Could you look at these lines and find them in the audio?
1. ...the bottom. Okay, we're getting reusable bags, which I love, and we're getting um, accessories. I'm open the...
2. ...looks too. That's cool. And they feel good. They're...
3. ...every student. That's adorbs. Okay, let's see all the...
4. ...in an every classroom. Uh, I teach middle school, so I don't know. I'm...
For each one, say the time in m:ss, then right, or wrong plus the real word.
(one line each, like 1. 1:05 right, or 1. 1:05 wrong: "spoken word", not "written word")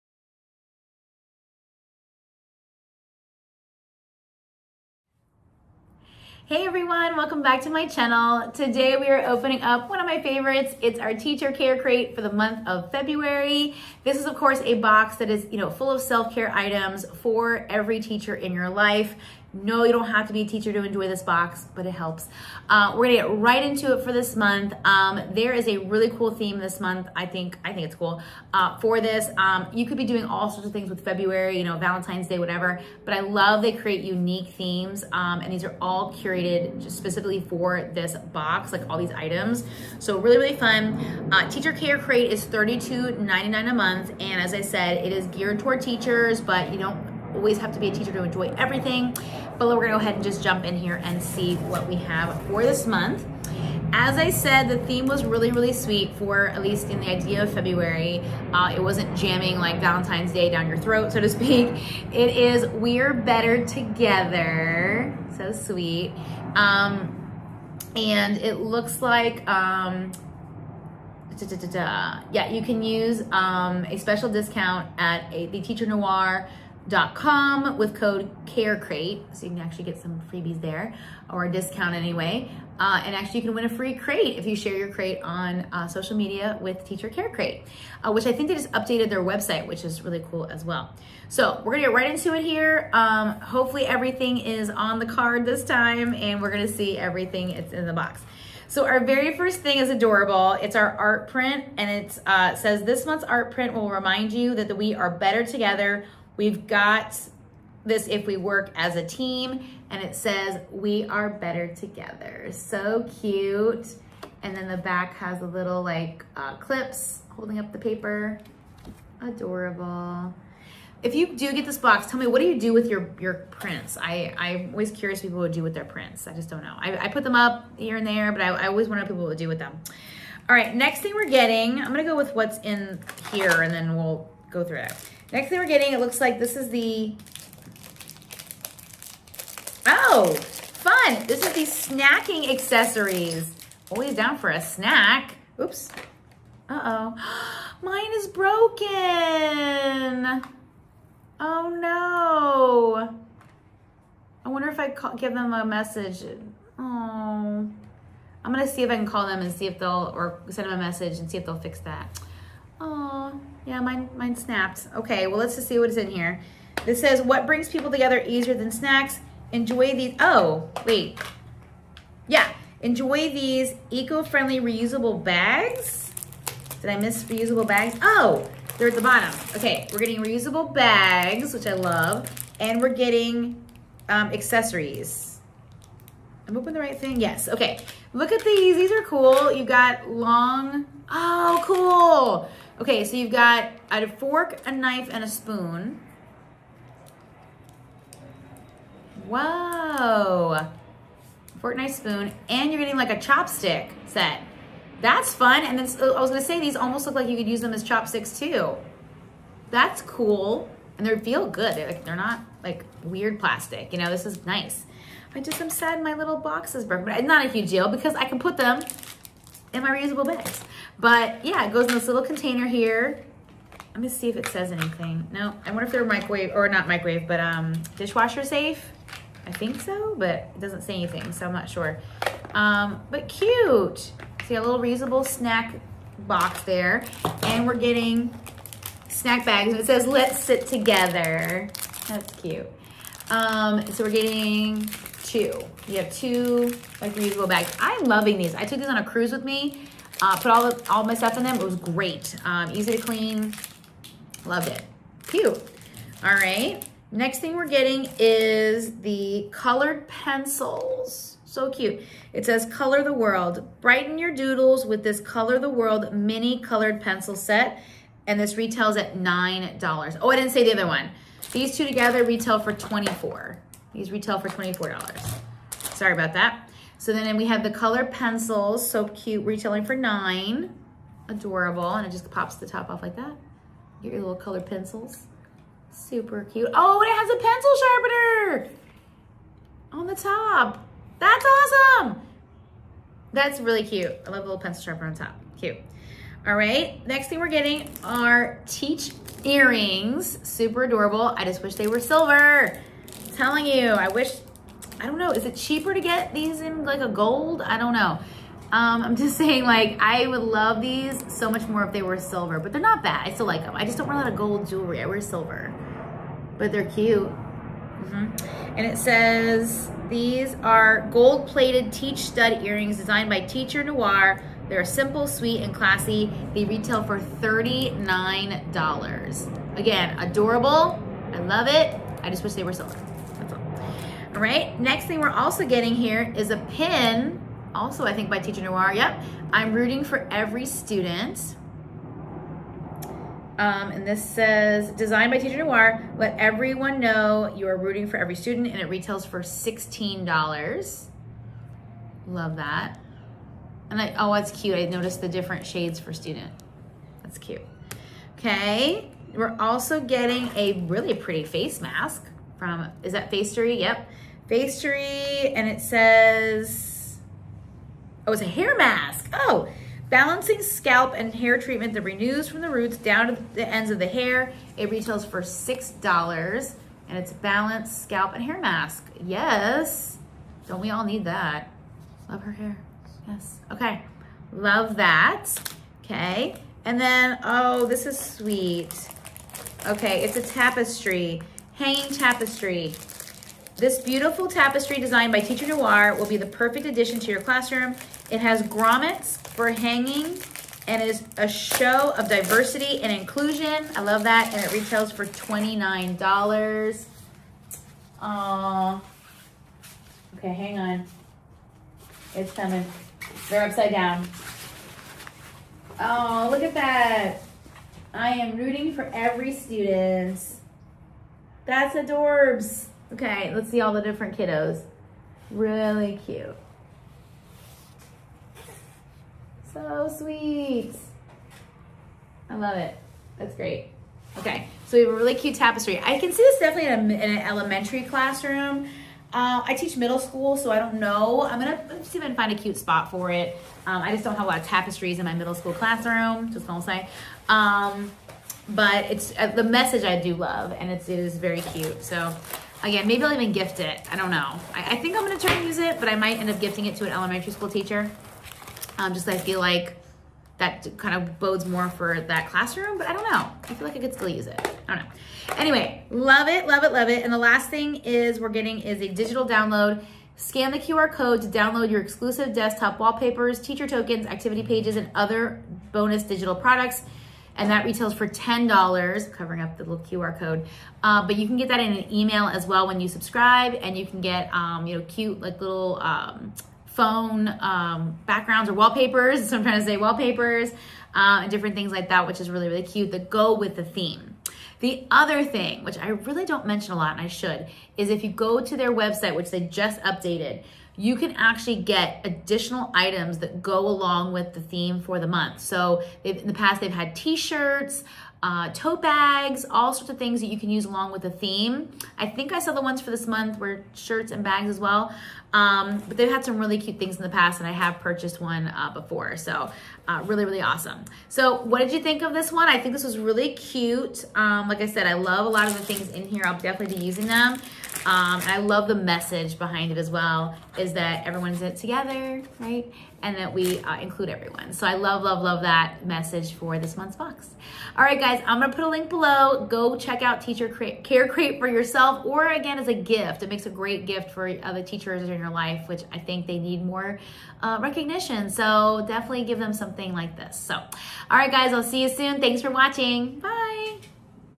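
1. 2:58 right
2. 3:27 wrong: "chopsticks", not "looks"
3. 6:59 right
4. 7:17 wrong: "elementary", not "every".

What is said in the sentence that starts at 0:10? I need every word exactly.
It's our teacher care crate for the month of February.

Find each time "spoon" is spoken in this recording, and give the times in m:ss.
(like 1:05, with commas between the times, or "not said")
3:15, 3:21.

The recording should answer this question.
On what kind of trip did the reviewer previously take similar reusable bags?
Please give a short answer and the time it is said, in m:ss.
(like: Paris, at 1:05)
A cruise, at 4:09.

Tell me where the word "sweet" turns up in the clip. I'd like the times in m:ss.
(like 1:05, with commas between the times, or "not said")
0:55, 1:05, 5:25, 6:28, 7:10.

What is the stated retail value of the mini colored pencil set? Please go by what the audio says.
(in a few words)
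$9.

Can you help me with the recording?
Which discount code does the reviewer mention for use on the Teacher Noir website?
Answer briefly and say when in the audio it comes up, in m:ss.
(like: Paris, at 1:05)
CareCrate, at 1:18.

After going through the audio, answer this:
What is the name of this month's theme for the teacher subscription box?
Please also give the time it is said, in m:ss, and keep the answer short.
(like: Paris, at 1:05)
We're Better Together, at 1:02.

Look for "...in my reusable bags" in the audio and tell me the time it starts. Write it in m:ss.
3:39.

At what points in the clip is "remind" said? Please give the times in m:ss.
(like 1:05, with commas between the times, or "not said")
1:43.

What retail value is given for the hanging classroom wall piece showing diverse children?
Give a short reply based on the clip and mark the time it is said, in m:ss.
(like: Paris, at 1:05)
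$29, at 6:45.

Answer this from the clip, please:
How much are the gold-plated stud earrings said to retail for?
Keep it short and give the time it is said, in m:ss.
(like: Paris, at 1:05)
$39, at 5:27.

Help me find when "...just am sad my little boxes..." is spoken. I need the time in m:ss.
3:35.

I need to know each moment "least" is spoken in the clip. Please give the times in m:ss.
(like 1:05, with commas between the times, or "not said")
0:56.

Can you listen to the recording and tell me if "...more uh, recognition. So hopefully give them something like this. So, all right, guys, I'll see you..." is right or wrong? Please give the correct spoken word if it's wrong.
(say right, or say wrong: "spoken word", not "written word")
wrong: "definitely", not "hopefully".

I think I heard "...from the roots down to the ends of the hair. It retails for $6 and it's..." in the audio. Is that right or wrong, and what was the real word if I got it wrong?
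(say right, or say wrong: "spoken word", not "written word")
right.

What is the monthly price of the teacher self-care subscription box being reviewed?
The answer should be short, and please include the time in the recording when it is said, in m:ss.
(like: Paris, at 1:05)
$32.99, at 0:42.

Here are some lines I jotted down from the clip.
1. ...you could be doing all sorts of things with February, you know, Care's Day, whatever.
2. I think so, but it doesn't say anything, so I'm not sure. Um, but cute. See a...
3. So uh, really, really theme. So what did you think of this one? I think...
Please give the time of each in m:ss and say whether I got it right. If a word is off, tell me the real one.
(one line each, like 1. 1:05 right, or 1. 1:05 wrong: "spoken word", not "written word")
1. 0:29 wrong: "Valentine", not "Care"
2. 3:49 right
3. 8:39 wrong: "awesome", not "theme".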